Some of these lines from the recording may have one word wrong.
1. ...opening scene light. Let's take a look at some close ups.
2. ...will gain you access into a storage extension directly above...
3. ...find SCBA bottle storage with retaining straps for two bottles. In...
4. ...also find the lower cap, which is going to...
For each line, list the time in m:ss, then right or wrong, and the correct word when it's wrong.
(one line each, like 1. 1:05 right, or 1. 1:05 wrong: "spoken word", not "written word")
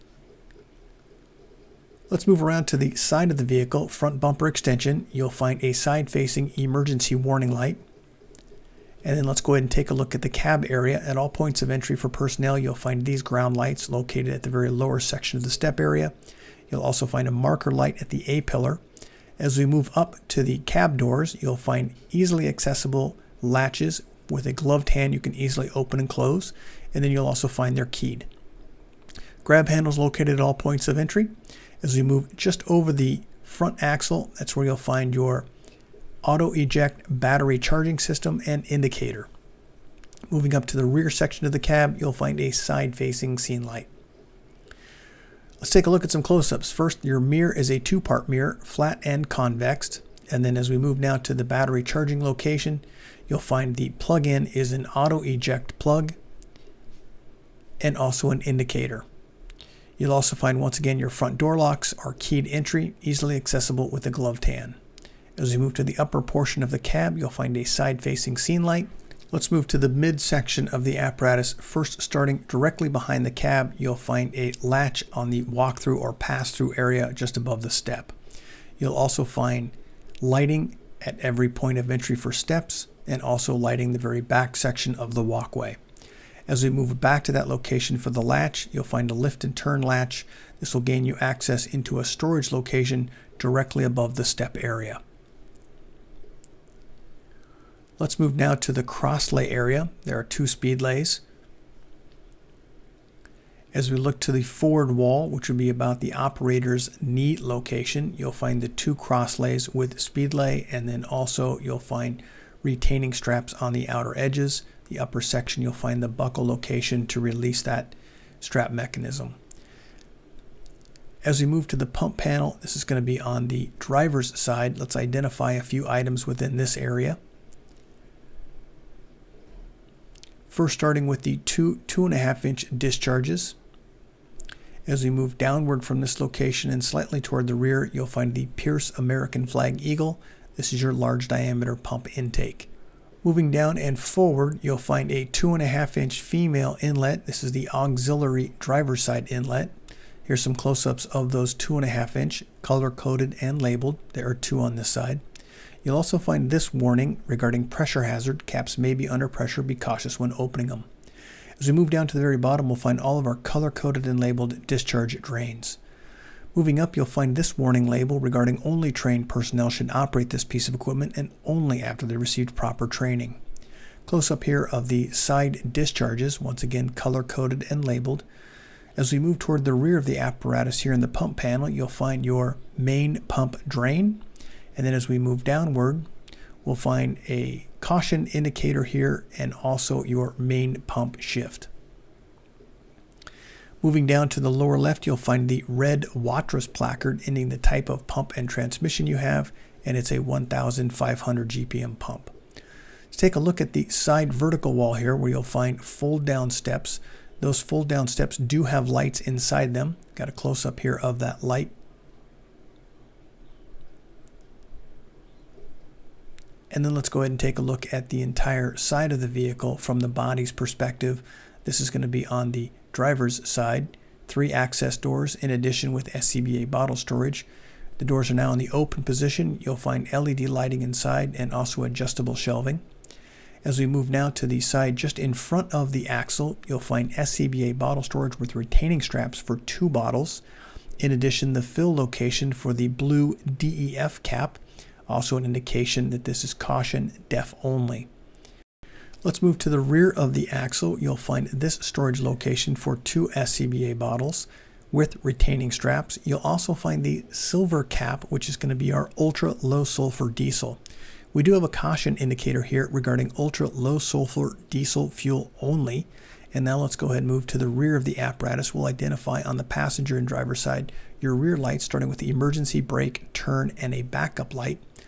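1. 0:42 wrong: "facing", not "opening"
2. 1:30 wrong: "location", not "extension"
3. 3:56 right
4. 4:16 wrong: "silver", not "lower".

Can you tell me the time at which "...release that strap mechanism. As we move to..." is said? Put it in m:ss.
1:57.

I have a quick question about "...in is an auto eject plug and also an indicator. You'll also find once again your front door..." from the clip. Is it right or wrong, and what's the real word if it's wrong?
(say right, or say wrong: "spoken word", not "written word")
right.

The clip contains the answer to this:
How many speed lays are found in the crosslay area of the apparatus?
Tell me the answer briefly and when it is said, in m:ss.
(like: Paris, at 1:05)
2, at 1:40.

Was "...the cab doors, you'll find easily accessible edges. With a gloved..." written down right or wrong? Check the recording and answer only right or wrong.
wrong.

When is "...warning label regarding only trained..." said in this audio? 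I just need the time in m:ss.
2:47.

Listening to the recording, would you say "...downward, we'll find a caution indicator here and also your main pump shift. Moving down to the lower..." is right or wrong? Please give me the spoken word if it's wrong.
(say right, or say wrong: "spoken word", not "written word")
right.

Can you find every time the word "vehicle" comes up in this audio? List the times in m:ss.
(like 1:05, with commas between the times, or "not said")
0:03, 3:39.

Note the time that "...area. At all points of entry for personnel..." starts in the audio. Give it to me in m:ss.
0:10.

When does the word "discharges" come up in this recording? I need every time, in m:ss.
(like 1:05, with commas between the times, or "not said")
2:12, 2:44, 2:55.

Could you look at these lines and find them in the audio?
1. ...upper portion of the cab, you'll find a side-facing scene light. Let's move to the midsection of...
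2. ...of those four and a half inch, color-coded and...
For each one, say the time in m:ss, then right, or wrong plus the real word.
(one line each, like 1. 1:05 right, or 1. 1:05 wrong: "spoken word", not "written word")
1. 1:05 right
2. 2:31 wrong: "two", not "four".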